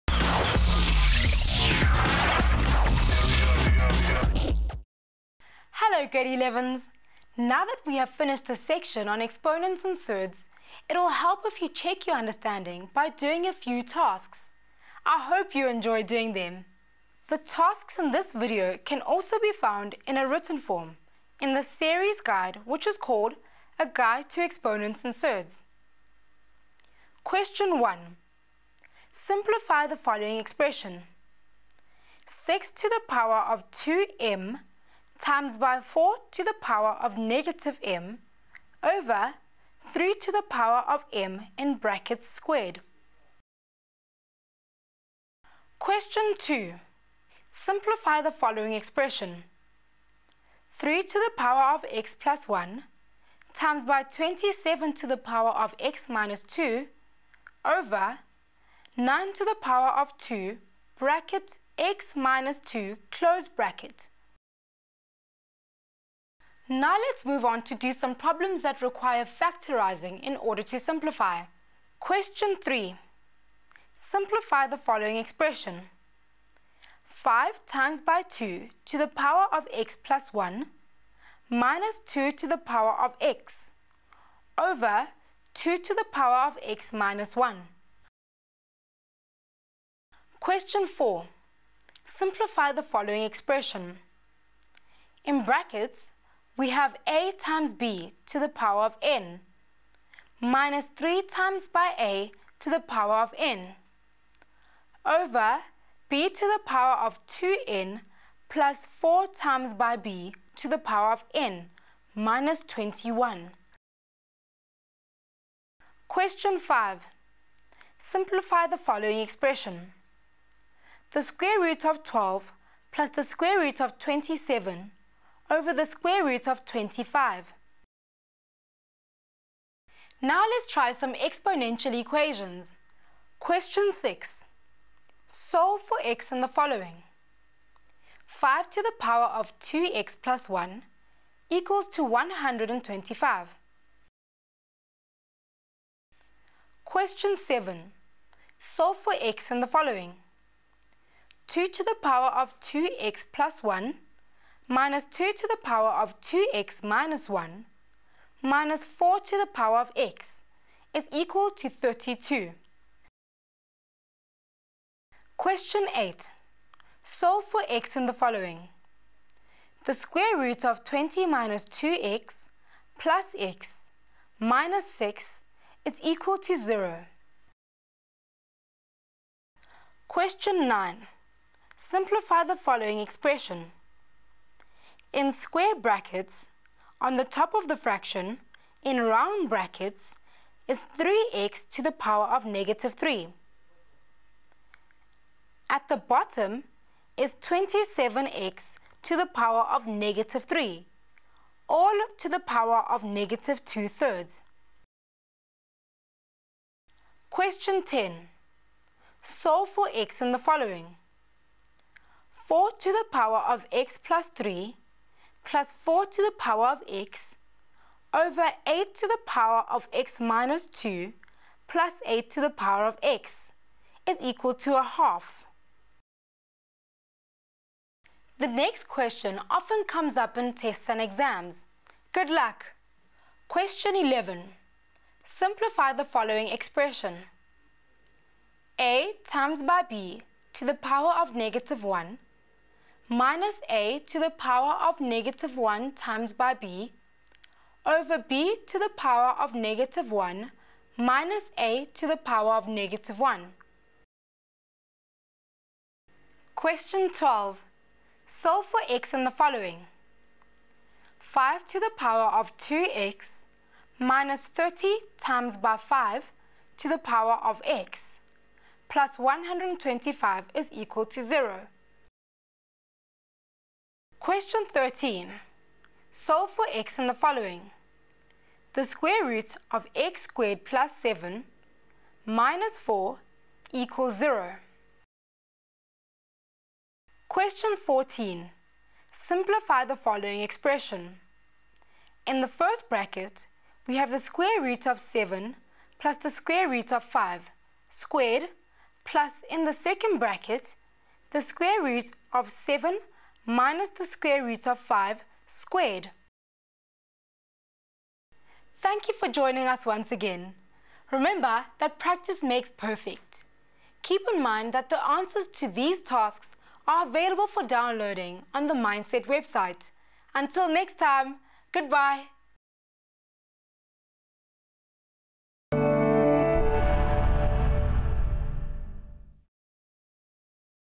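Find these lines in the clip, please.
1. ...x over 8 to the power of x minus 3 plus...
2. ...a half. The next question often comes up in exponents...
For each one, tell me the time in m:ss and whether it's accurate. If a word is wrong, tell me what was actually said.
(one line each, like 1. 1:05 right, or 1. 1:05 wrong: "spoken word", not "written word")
1. 3:36 wrong: "2", not "3"
2. 3:44 wrong: "tests", not "exponents".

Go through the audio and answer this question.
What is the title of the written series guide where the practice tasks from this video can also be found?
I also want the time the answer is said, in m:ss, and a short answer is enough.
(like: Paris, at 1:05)
A Guide to Exponents and Surds, at 0:23.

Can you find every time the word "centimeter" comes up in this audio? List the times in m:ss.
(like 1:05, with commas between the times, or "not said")
not said.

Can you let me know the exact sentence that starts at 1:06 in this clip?
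Now let's move on to do some problems that require factorizing in order to simplify.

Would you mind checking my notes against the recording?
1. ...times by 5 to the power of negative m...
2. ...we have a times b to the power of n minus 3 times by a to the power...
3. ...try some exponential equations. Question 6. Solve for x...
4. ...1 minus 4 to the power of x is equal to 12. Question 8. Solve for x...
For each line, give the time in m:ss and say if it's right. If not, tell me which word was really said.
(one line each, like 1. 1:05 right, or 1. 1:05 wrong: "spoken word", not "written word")
1. 0:35 wrong: "4", not "5"
2. 1:36 right
3. 2:10 right
4. 2:37 wrong: "32", not "12".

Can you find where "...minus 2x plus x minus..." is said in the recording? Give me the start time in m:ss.
2:51.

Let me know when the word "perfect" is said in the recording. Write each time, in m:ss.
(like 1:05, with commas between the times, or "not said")
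5:12.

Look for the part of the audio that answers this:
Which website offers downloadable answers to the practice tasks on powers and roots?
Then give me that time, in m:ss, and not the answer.
5:18.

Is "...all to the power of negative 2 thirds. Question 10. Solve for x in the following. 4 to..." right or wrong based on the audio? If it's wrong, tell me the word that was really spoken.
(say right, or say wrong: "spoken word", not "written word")
right.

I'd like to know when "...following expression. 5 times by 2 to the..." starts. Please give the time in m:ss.
1:14.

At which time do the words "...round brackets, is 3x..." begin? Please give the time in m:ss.
3:09.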